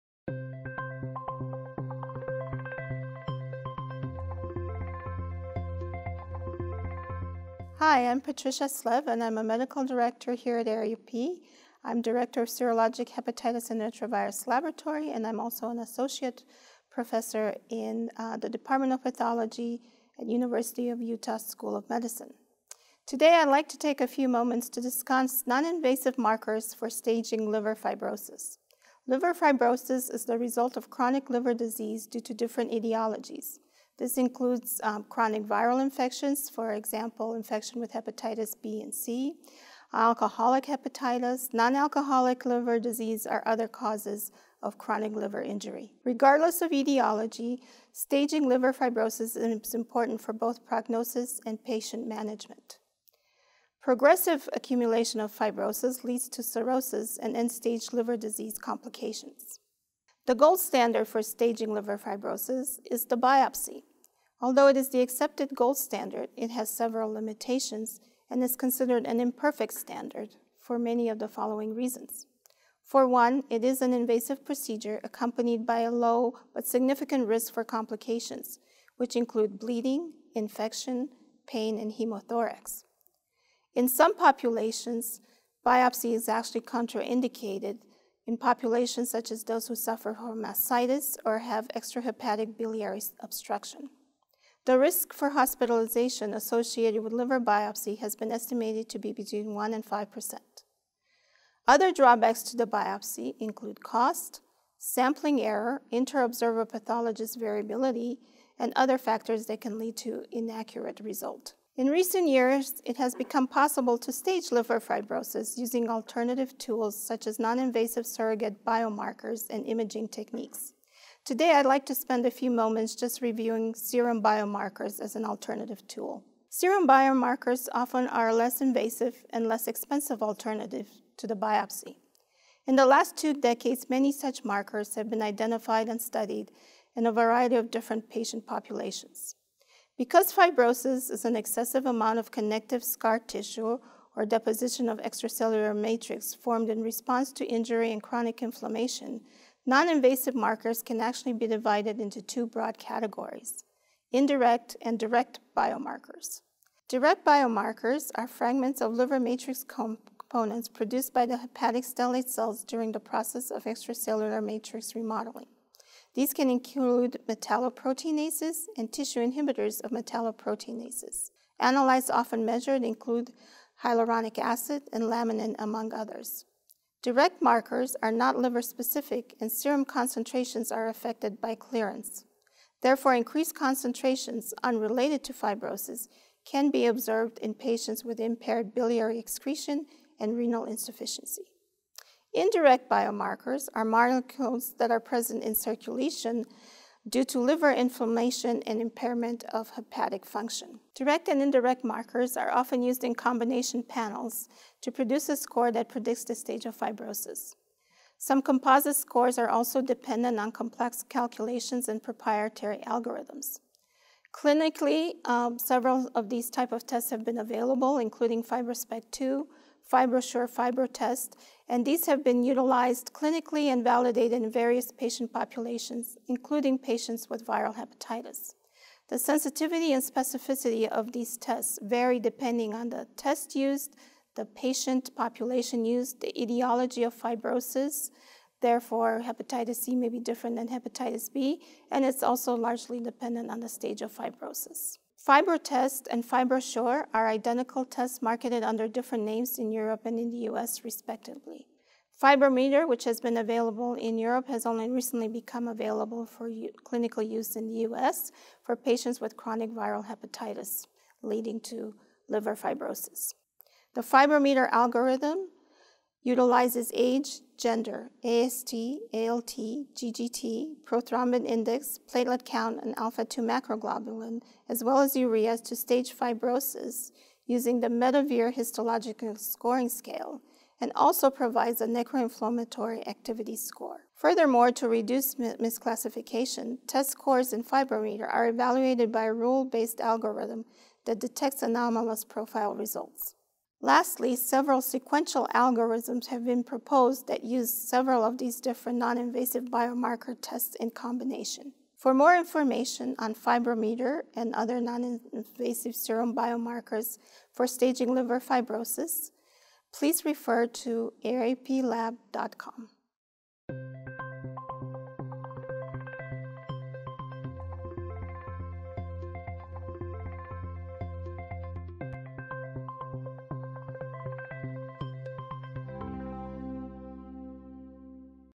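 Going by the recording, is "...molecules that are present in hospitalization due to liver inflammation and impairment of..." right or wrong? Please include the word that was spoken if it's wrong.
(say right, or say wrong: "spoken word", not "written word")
wrong: "circulation", not "hospitalization".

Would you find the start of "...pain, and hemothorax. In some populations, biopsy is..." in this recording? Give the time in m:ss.
1:21.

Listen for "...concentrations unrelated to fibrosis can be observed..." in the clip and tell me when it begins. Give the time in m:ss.
3:03.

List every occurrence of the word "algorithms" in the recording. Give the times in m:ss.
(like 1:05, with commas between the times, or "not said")
3:32, 4:24, 4:49, 4:55.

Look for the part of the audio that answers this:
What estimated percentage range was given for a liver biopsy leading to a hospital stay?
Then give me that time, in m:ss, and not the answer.
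1:39.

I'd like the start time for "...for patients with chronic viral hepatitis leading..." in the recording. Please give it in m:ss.
4:18.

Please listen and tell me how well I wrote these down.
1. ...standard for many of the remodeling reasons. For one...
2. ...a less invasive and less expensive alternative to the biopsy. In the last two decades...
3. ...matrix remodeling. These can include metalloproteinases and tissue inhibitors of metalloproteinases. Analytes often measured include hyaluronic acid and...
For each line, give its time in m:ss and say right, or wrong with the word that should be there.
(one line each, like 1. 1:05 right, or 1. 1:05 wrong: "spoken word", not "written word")
1. 1:09 wrong: "following", not "remodeling"
2. 2:08 right
3. 2:44 right.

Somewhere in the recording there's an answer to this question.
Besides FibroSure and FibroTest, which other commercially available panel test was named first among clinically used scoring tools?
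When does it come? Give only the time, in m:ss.
3:38.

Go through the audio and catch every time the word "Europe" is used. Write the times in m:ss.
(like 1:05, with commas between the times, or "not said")
4:09, 4:14.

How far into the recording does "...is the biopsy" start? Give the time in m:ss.
1:02.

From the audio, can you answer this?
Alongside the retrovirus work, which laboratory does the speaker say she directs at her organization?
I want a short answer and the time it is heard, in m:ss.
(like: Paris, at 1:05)
Serologic hepatitis, at 0:12.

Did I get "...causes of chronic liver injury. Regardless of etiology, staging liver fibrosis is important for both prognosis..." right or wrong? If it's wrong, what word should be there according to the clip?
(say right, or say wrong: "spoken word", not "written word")
right.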